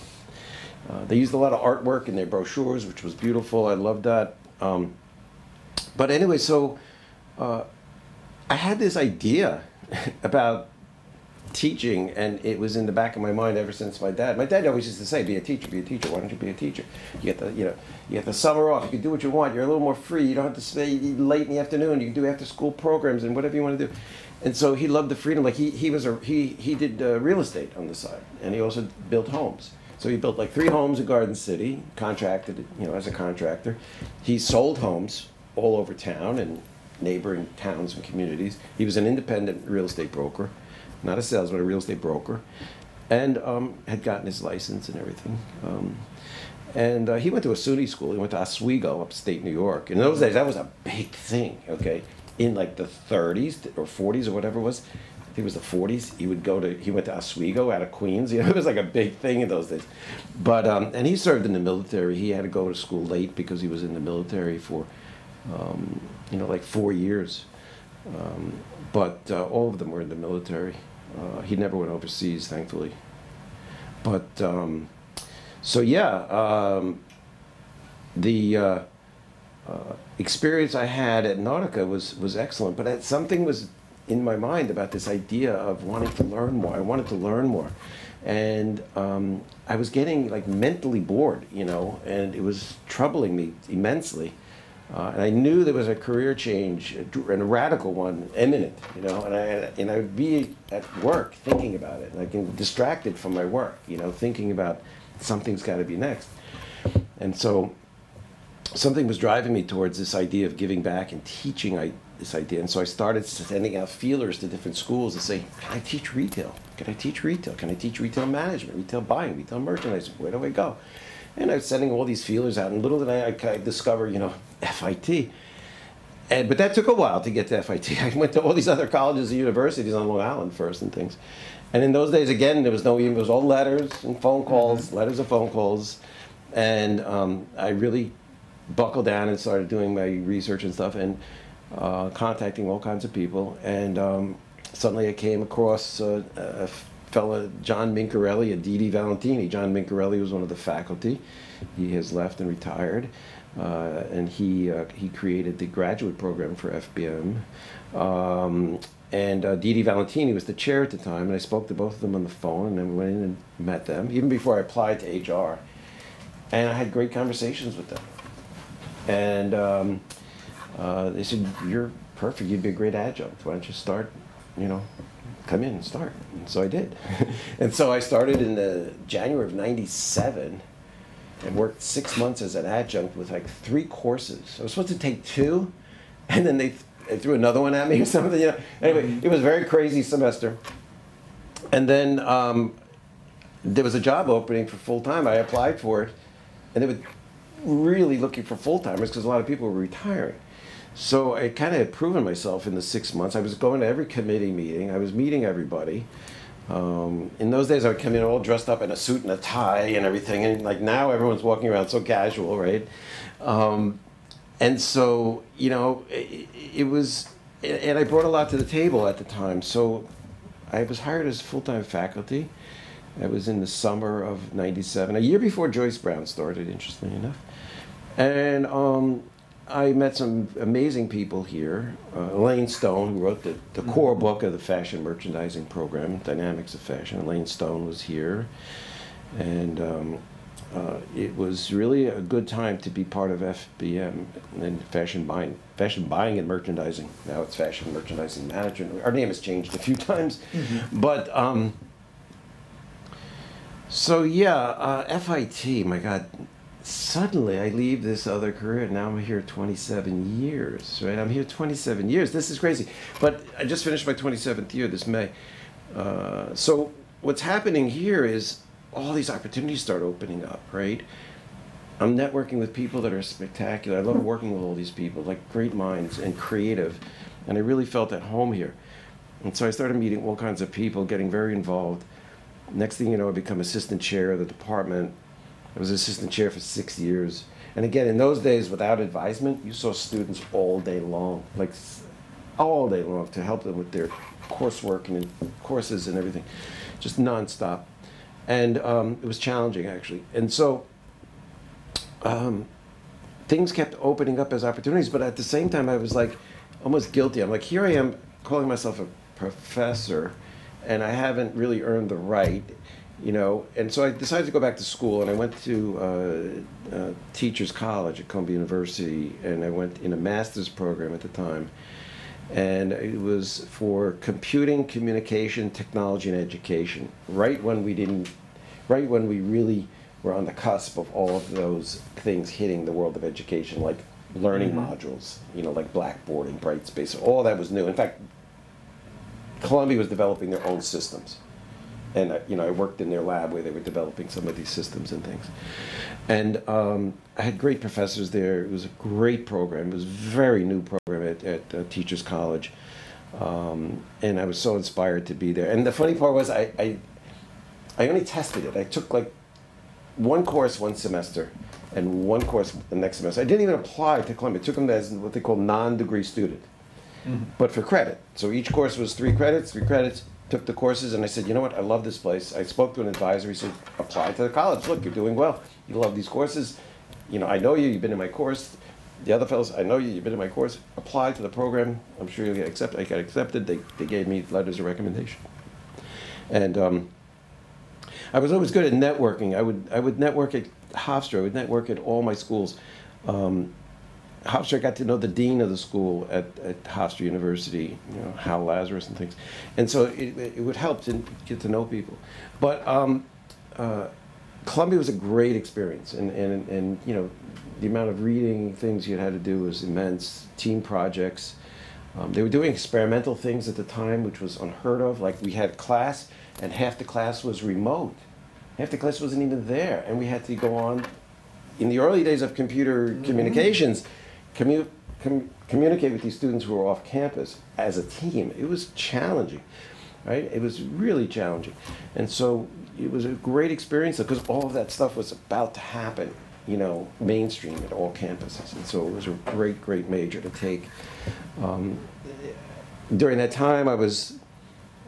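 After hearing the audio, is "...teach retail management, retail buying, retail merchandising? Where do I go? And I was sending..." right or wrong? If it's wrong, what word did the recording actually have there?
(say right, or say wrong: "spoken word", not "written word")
right.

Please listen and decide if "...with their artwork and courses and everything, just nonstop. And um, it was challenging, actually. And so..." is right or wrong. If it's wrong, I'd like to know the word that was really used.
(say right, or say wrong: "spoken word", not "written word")
wrong: "coursework", not "artwork".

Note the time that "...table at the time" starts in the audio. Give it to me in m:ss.
3:38.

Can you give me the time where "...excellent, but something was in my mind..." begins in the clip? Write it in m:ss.
1:22.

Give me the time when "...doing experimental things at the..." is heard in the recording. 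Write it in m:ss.
6:52.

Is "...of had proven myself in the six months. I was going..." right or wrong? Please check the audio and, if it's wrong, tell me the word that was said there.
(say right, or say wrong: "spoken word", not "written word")
right.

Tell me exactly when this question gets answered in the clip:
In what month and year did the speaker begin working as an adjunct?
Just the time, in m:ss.
2:59.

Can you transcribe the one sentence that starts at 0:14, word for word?
My dad always used to say, "Be a teacher, be a teacher.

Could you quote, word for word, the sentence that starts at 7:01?
In the early days of computer mm -hmm.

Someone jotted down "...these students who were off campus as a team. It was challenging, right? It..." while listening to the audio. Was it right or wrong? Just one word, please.
right.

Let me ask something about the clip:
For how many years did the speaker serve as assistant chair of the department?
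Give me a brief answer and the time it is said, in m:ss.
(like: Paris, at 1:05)
6, at 4:46.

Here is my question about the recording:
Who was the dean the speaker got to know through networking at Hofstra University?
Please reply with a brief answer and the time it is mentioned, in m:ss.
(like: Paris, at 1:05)
Hal Lazarus, at 6:38.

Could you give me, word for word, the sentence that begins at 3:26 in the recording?
Um, in those days, I would come in all dressed up in a suit and a tie and everything.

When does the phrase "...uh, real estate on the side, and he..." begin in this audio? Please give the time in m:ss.
0:27.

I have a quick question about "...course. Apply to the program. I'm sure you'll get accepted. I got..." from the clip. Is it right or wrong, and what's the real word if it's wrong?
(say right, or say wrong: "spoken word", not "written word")
right.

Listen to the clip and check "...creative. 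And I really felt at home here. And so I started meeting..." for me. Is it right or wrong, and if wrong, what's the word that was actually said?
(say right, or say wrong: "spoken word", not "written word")
right.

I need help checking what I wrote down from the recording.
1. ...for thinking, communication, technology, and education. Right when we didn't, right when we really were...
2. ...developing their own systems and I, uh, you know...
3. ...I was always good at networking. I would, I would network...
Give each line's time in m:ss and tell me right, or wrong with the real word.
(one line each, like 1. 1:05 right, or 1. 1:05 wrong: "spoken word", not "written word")
1. 5:23 wrong: "computing", not "thinking"
2. 5:40 right
3. 6:28 right.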